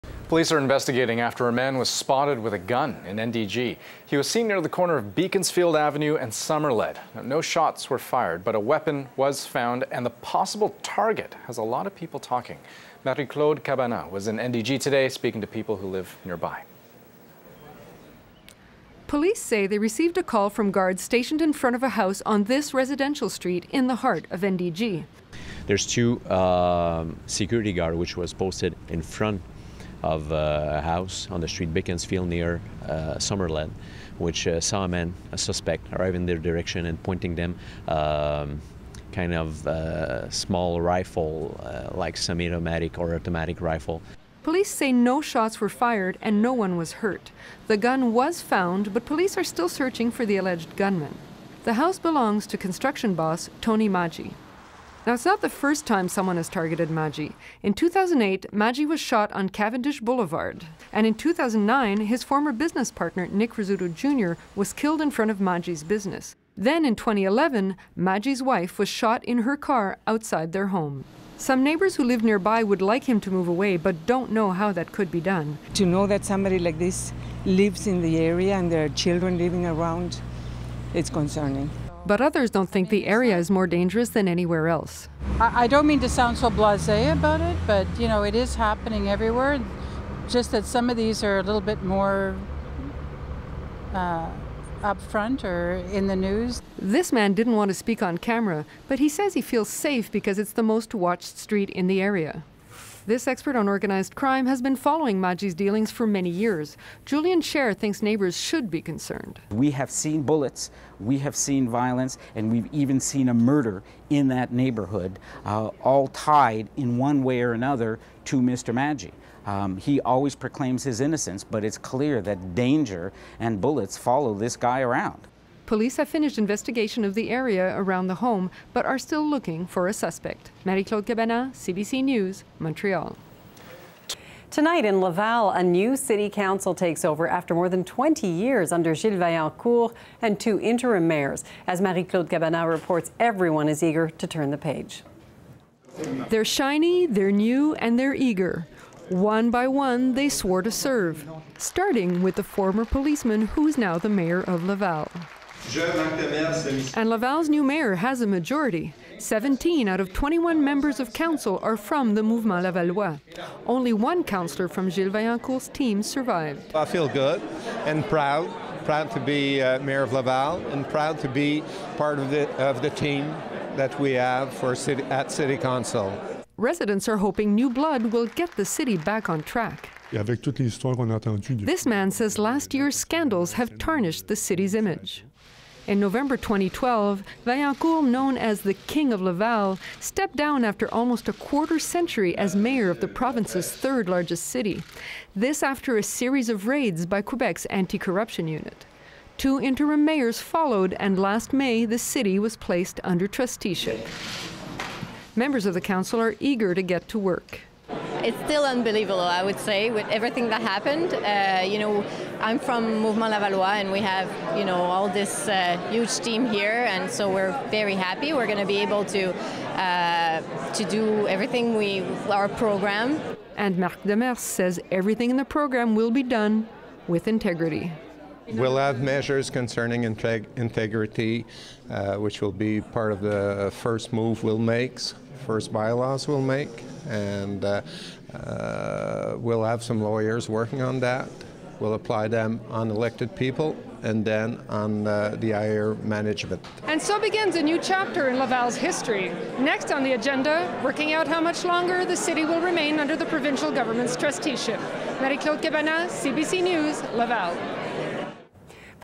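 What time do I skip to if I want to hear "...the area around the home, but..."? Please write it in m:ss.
2:07.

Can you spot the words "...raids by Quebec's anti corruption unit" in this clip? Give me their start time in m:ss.
3:16.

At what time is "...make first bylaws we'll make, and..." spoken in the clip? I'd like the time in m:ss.
3:54.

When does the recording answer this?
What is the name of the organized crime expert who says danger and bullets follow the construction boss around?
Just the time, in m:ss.
1:47.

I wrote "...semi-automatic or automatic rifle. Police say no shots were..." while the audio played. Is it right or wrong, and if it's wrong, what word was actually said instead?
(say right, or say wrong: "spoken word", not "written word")
right.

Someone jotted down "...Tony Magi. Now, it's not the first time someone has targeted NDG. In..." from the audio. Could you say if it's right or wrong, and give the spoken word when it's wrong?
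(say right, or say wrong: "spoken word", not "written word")
wrong: "Magi", not "NDG".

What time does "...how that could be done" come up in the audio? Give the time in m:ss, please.
1:14.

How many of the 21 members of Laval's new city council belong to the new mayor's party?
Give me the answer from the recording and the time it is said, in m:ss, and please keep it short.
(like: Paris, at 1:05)
17, at 2:39.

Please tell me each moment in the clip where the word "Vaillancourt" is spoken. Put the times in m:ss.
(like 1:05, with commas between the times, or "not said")
2:19, 2:45, 3:07.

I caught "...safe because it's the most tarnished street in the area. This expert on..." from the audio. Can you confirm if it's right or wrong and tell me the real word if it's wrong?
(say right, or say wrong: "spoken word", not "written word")
wrong: "watched", not "tarnished".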